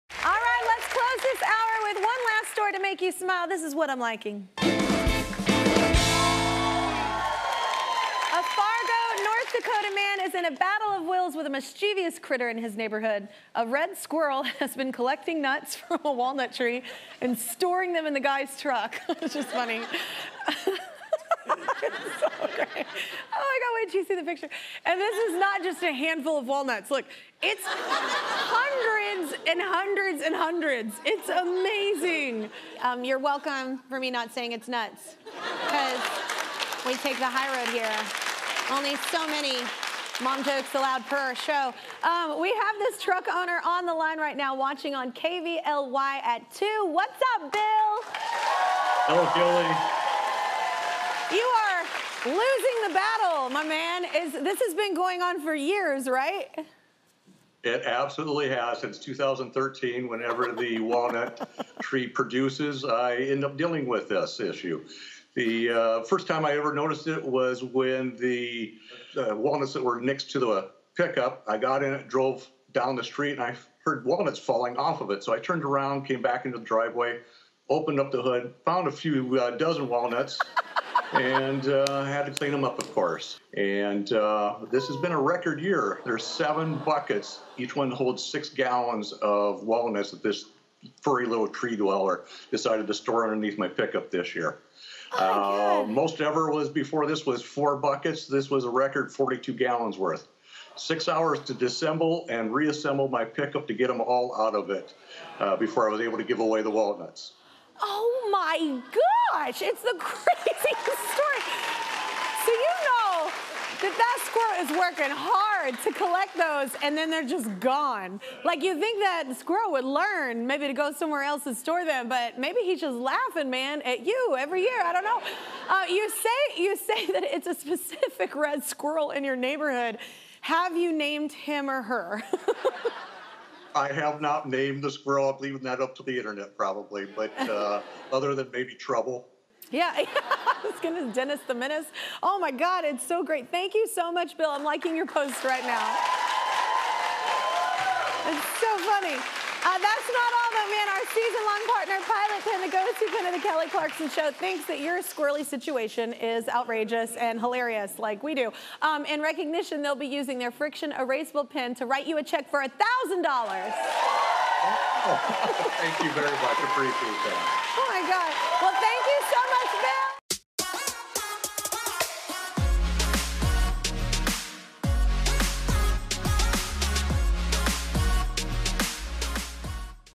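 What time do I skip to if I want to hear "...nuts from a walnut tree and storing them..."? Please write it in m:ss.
0:15.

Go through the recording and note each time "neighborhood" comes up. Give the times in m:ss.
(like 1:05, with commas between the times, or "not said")
0:12, 2:09.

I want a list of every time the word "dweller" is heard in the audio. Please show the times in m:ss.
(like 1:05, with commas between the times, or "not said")
1:31.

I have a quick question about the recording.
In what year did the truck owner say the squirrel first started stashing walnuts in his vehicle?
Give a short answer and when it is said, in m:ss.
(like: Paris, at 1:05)
2013, at 0:58.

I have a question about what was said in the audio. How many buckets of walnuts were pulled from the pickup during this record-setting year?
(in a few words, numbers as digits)
7.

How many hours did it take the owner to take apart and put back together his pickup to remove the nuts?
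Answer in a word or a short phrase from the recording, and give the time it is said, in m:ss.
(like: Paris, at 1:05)
6, at 1:40.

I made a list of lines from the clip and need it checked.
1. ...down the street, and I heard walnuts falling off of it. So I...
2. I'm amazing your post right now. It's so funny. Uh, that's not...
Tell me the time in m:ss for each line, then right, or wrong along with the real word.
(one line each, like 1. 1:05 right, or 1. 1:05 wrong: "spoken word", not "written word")
1. 1:12 right
2. 2:24 wrong: "liking", not "amazing".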